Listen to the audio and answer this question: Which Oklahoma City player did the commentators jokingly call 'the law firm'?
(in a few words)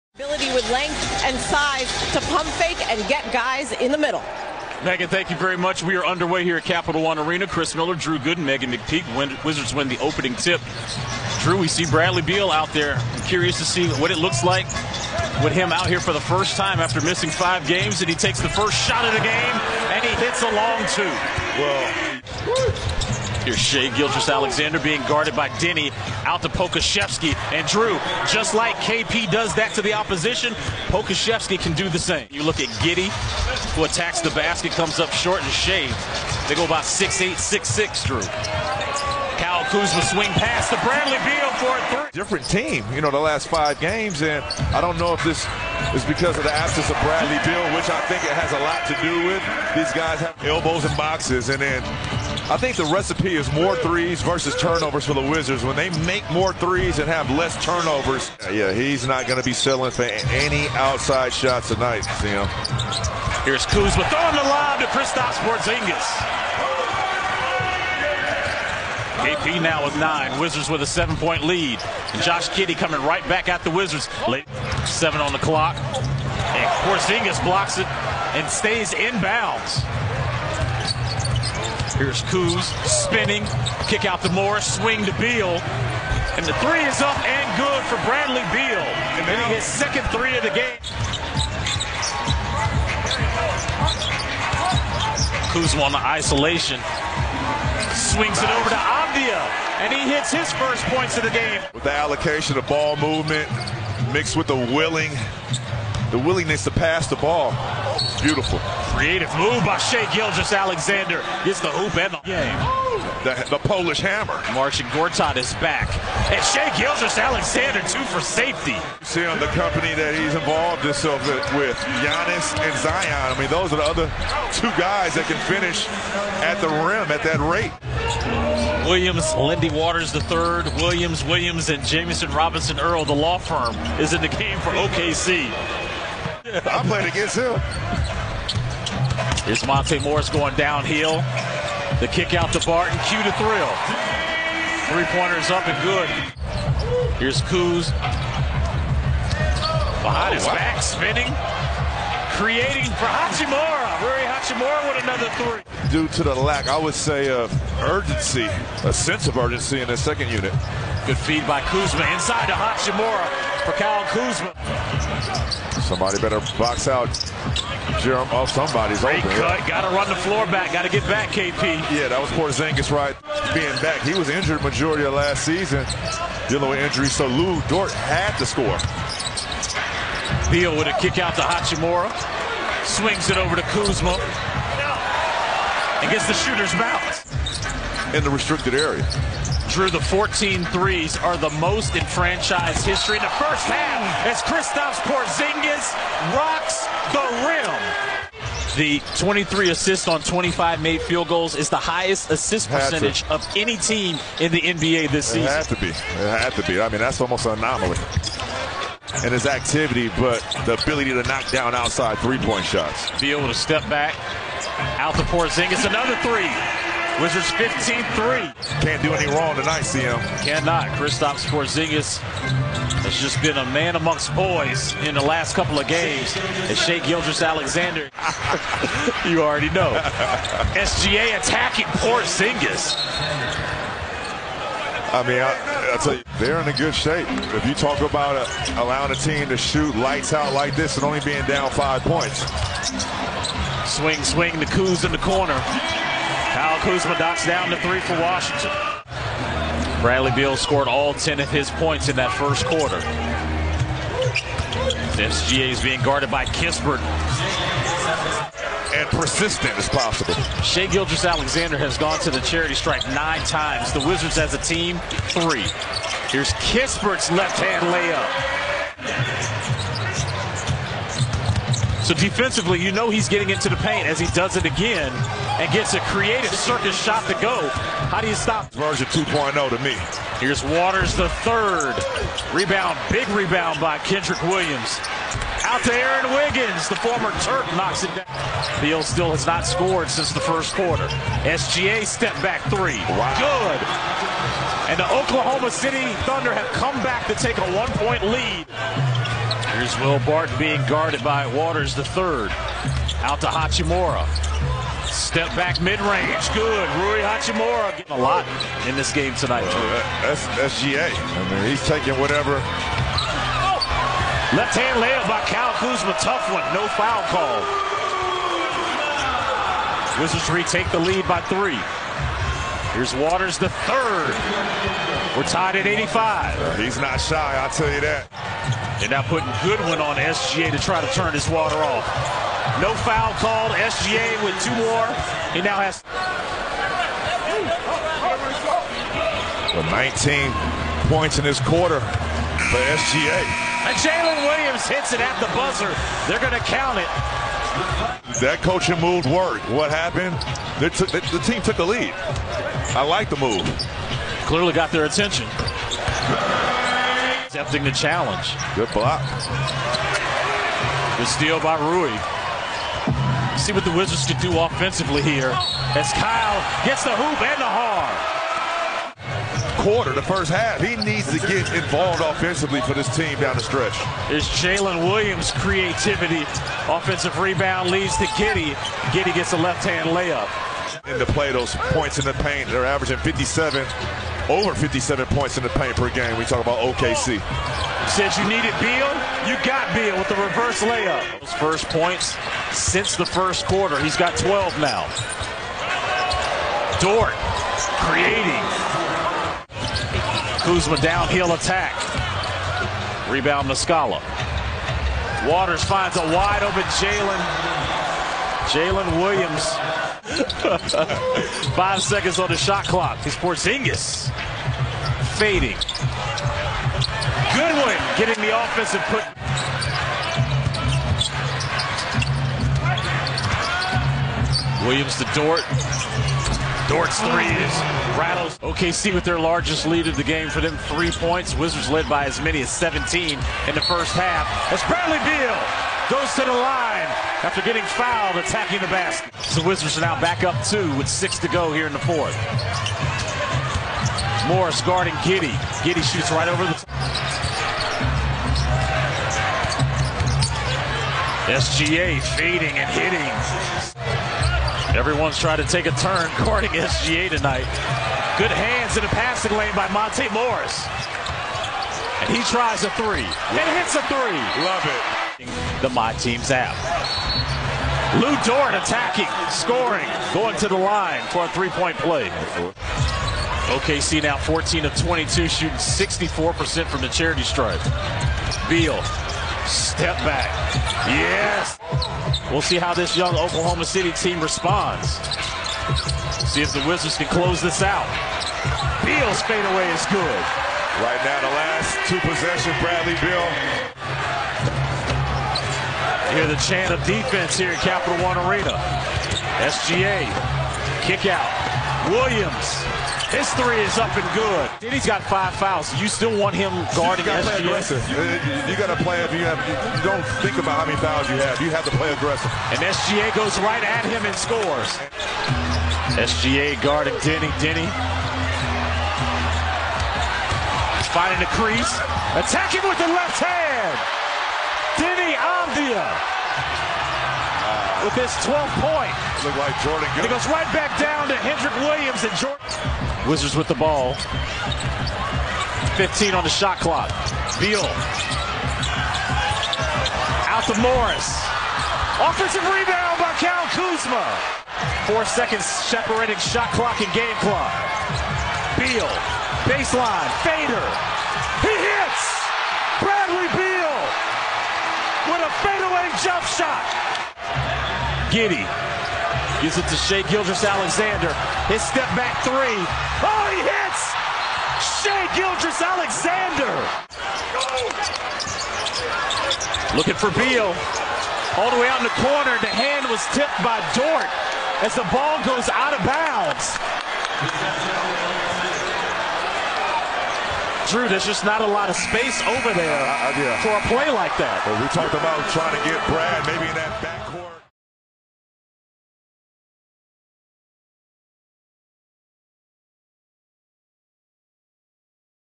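Jeremiah Robinson-Earl.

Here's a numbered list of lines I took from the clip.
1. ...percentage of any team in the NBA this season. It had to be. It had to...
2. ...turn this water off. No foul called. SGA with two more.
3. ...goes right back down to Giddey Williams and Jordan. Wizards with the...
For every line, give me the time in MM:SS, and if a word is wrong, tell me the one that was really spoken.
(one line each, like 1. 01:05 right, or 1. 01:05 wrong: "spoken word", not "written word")
1. 03:22 right
2. 05:31 right
3. 08:50 wrong: "Kenrich", not "Giddey".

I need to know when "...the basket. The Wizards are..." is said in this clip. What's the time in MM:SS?
07:18.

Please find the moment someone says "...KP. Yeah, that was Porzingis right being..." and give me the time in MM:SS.
02:51.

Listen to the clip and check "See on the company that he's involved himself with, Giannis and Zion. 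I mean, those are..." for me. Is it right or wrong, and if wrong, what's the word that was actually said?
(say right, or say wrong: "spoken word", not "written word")
right.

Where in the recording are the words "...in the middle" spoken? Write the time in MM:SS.
00:03.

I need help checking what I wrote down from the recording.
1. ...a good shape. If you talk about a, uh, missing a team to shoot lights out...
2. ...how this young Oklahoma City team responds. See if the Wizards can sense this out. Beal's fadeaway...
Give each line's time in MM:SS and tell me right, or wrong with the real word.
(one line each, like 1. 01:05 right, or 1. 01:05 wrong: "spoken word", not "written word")
1. 03:56 wrong: "allowing", not "missing"
2. 08:02 wrong: "close", not "sense".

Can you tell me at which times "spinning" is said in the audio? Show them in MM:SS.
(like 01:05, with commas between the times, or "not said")
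01:22, 02:30.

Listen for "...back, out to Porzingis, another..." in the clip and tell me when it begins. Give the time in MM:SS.
03:33.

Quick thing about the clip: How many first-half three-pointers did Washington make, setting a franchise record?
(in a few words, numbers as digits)
14.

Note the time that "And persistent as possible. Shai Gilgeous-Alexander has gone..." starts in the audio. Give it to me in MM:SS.
04:18.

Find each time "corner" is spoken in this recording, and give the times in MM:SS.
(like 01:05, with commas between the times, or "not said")
04:05, 09:32.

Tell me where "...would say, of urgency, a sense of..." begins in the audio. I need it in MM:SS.
02:36.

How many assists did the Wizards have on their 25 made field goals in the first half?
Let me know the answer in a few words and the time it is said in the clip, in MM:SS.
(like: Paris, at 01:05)
23, at 03:19.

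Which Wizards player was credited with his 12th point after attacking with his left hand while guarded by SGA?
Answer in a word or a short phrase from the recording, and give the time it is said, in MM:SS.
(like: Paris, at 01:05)
Deni Avdija, at 08:44.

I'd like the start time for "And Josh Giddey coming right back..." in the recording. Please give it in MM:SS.
01:12.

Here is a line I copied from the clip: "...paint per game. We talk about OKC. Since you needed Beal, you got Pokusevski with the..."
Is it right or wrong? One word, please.
wrong.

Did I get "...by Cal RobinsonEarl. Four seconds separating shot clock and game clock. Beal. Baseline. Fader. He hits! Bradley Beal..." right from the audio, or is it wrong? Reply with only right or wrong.
wrong.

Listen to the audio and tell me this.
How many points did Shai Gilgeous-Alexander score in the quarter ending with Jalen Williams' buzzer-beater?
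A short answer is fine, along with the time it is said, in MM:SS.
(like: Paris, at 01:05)
19, at 05:39.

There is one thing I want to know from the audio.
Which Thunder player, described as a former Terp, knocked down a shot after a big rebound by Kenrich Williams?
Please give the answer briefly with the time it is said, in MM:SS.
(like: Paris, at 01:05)
Aaron Wiggins, at 04:45.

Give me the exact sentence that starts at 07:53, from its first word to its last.
OKC now 14 of 22, shooting 64% from the charity stripe.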